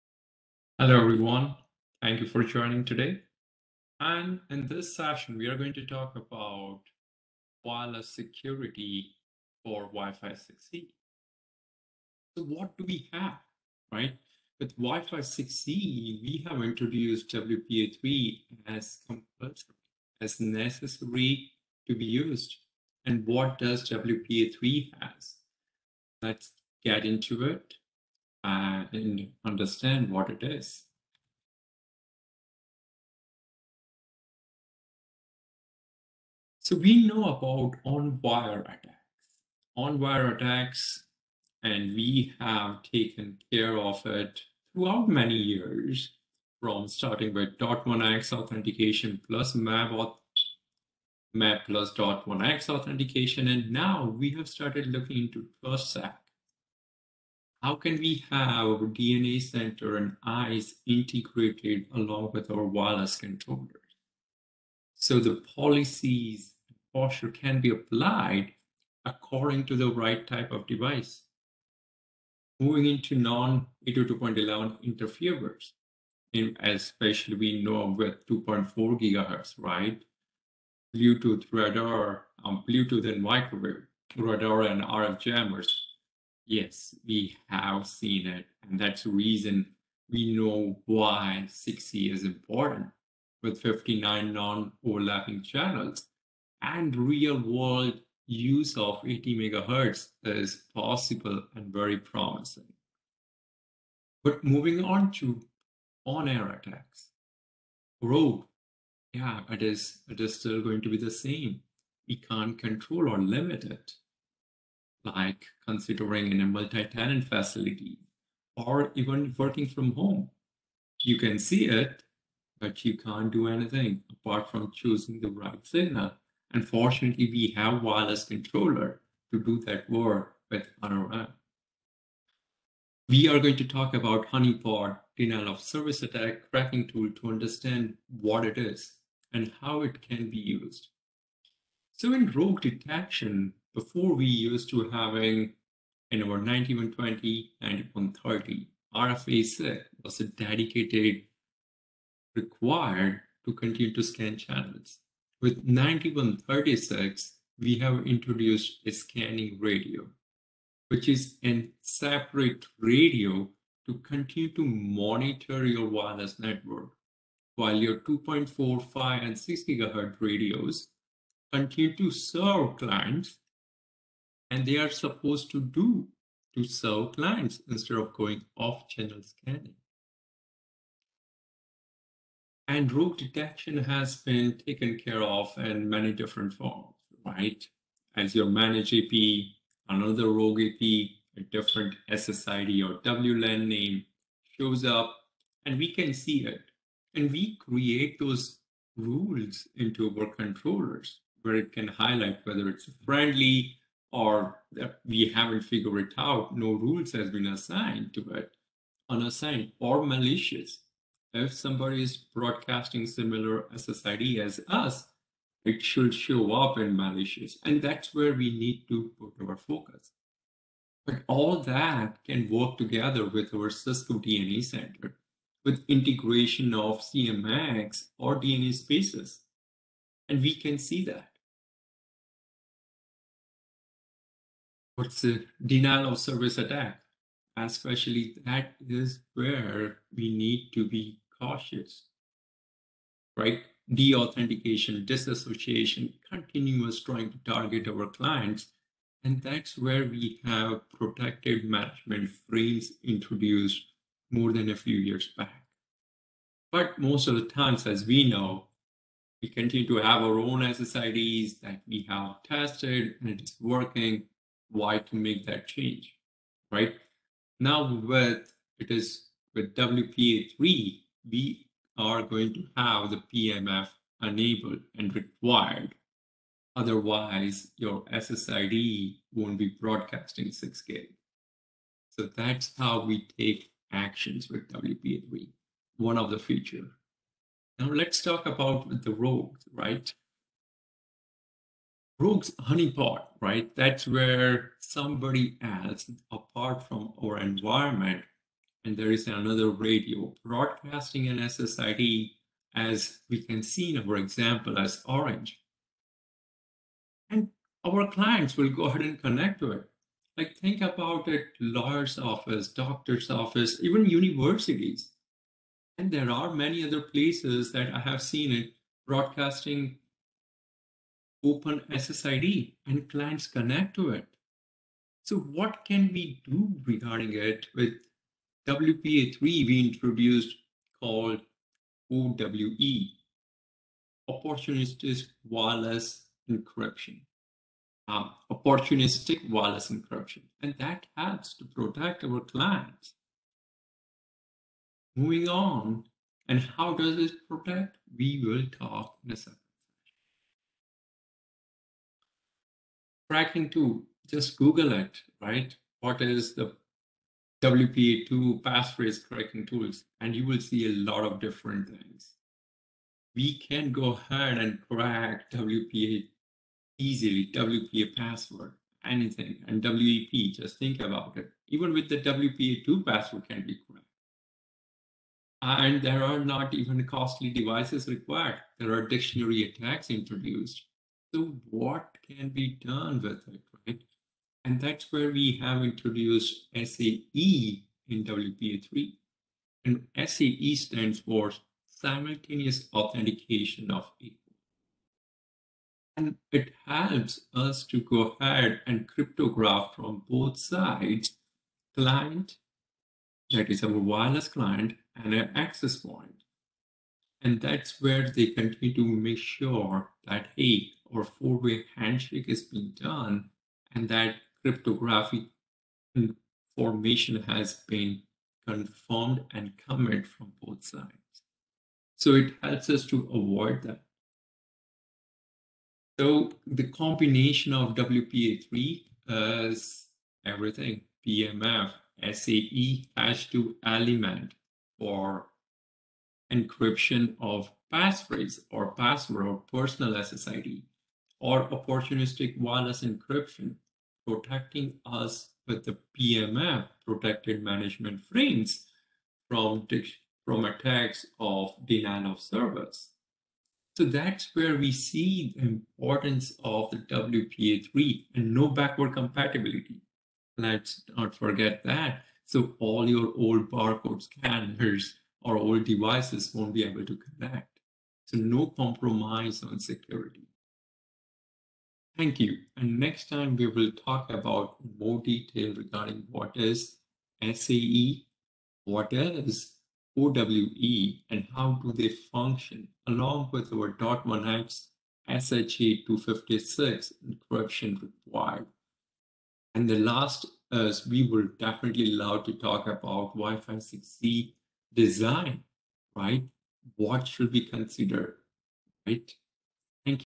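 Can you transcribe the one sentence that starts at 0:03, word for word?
And in this session, we are going to talk about wireless security for Wi-Fi 6E.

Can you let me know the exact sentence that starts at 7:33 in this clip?
So that's where we see the importance of the WPA3 and no backward compatibility.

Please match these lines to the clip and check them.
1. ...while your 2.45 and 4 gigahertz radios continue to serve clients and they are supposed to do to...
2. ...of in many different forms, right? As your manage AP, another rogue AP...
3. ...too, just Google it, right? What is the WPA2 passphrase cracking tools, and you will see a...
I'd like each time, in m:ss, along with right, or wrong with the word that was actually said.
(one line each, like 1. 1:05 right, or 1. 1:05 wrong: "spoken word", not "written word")
1. 2:47 wrong: "6", not "4"
2. 3:05 right
3. 5:53 right.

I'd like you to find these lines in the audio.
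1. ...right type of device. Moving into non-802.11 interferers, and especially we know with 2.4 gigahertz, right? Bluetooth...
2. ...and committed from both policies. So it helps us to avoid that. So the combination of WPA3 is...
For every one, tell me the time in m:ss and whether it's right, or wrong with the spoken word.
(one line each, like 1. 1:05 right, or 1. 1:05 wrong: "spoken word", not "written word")
1. 1:09 right
2. 6:59 wrong: "sides", not "policies".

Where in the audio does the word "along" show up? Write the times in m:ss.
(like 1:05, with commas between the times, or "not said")
1:01, 8:03.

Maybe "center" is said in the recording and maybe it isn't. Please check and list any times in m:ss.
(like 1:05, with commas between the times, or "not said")
0:59, 3:44.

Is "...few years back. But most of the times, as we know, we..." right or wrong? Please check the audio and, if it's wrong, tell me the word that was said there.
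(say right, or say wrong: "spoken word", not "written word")
right.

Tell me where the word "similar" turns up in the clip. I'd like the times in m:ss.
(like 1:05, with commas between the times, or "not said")
3:33.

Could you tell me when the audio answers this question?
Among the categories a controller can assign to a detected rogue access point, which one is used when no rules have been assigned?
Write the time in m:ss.
3:29.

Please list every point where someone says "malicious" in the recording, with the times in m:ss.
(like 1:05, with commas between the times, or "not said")
3:30, 3:36.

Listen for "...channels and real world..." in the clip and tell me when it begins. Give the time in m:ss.
1:35.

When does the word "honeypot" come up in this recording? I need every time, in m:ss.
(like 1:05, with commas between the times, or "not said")
2:14, 4:52.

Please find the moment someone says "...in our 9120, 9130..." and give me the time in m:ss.
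2:26.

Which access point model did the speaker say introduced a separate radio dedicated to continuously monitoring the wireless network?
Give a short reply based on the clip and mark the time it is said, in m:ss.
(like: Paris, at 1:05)
9136, at 2:35.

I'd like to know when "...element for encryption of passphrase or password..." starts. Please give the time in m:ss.
7:13.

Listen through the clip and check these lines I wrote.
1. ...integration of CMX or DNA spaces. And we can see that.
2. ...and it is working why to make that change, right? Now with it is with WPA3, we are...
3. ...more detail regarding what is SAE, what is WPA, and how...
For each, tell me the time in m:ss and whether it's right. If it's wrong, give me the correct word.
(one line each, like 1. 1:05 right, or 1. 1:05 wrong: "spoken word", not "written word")
1. 3:45 right
2. 4:23 right
3. 7:54 wrong: "OWE", not "WPA".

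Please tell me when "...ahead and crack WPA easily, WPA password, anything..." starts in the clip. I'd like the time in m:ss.
6:04.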